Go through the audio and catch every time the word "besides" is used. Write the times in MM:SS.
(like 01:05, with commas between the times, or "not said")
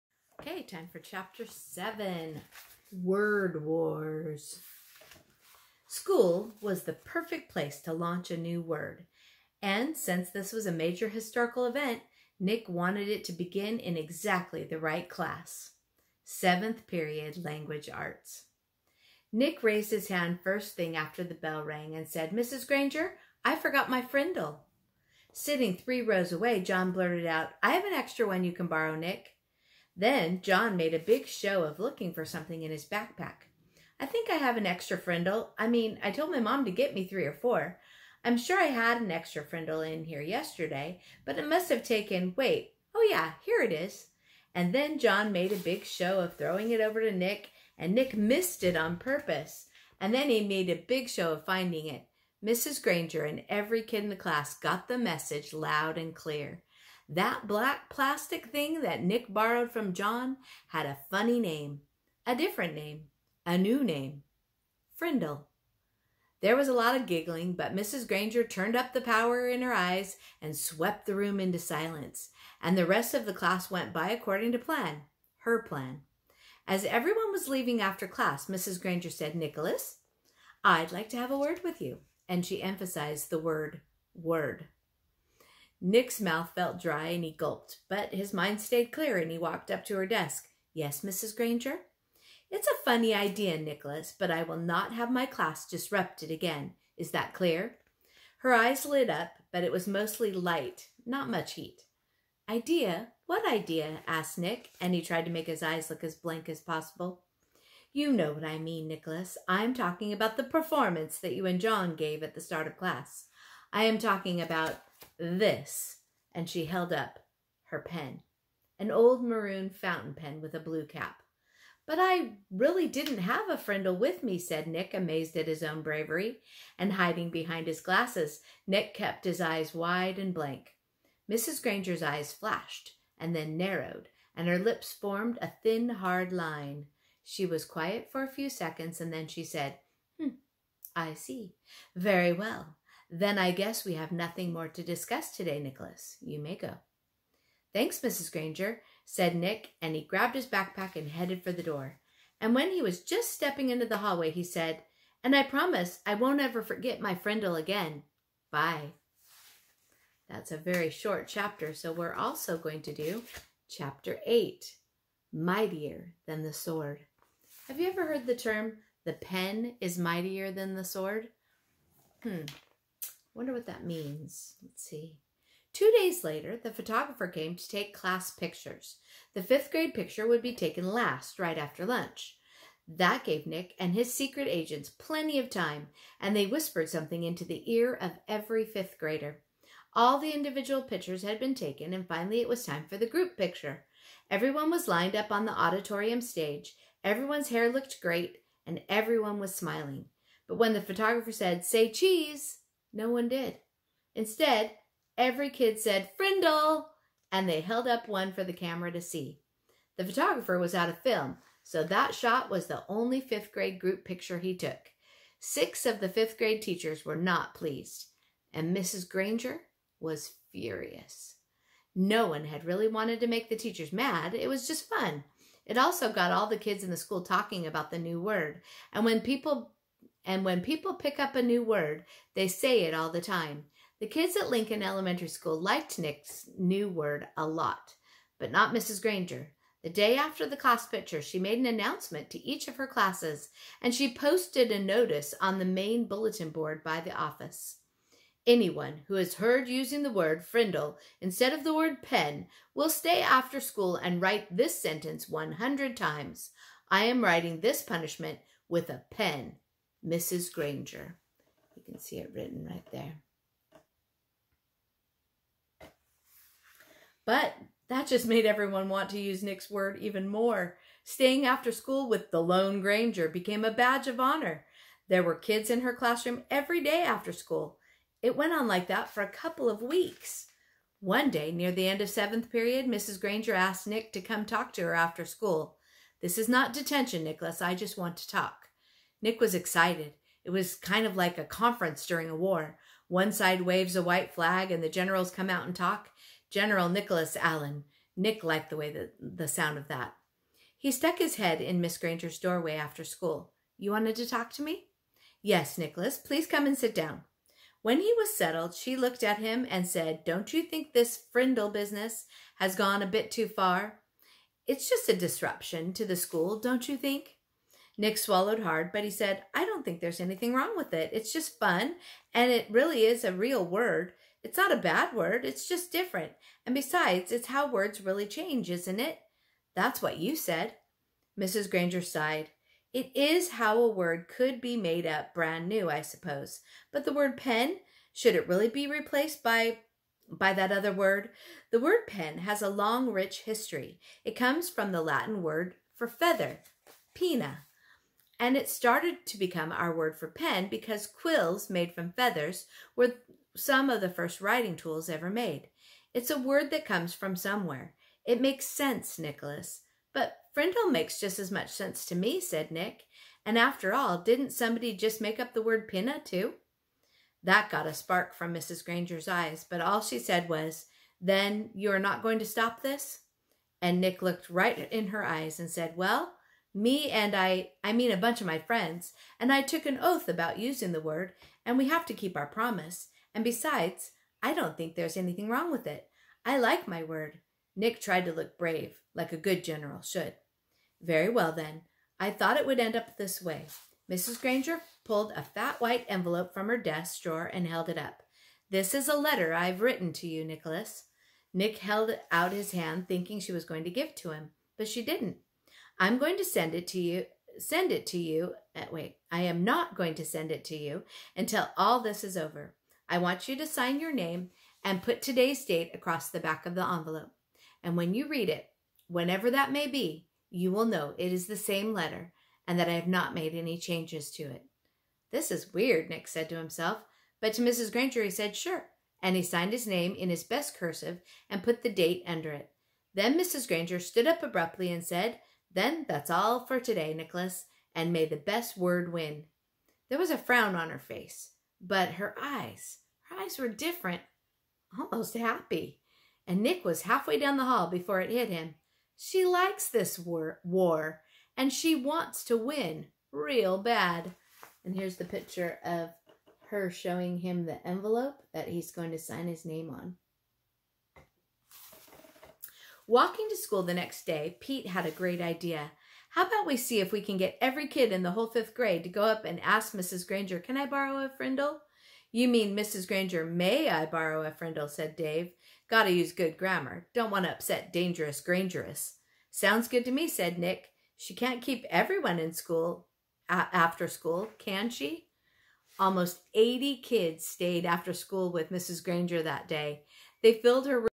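05:26, 06:23.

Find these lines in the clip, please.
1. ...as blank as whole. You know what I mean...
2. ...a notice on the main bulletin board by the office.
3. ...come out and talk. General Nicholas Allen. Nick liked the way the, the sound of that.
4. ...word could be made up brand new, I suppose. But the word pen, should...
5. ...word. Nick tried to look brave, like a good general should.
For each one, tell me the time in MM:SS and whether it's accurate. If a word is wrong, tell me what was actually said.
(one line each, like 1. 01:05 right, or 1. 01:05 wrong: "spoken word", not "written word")
1. 01:46 wrong: "possible", not "whole"
2. 04:04 right
3. 04:55 right
4. 05:33 right
5. 06:27 right.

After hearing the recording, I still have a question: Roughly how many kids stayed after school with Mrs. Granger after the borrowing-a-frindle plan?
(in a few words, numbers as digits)
80.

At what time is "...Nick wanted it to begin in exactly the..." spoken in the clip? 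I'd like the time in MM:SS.
00:12.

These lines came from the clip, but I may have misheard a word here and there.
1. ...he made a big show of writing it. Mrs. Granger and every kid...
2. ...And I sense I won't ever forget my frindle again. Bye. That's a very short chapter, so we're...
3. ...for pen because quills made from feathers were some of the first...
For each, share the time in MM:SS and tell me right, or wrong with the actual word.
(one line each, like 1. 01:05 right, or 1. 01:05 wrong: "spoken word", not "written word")
1. 00:50 wrong: "finding", not "writing"
2. 02:35 wrong: "promise", not "sense"
3. 05:50 right.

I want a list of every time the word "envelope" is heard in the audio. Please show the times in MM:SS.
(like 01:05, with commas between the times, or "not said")
06:36, 06:56, 07:37.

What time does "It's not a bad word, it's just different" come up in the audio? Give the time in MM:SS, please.
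05:24.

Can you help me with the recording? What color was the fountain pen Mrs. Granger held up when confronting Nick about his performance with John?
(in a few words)
maroon.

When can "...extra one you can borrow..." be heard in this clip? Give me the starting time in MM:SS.
00:27.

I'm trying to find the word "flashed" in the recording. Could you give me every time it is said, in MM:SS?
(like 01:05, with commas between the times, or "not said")
02:12.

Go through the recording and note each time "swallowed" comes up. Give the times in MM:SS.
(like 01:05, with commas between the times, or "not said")
05:18.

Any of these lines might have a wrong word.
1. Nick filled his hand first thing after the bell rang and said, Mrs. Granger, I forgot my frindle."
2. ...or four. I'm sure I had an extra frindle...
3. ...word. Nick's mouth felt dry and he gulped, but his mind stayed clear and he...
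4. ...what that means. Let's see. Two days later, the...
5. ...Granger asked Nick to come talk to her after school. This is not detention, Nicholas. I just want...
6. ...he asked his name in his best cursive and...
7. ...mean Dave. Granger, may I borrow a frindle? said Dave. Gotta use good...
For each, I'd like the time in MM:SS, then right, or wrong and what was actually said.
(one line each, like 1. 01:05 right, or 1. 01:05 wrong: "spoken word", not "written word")
1. 00:19 wrong: "raised", not "filled"
2. 00:37 right
3. 01:24 right
4. 02:53 right
5. 04:43 right
6. 07:09 wrong: "signed", not "asked"
7. 07:52 wrong: "Mrs", not "Dave".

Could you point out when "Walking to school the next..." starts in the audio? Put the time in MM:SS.
07:43.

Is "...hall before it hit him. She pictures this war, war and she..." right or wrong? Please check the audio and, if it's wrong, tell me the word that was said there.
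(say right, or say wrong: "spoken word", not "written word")
wrong: "likes", not "pictures".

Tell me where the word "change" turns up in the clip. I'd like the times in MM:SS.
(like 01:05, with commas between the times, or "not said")
05:28, 07:03.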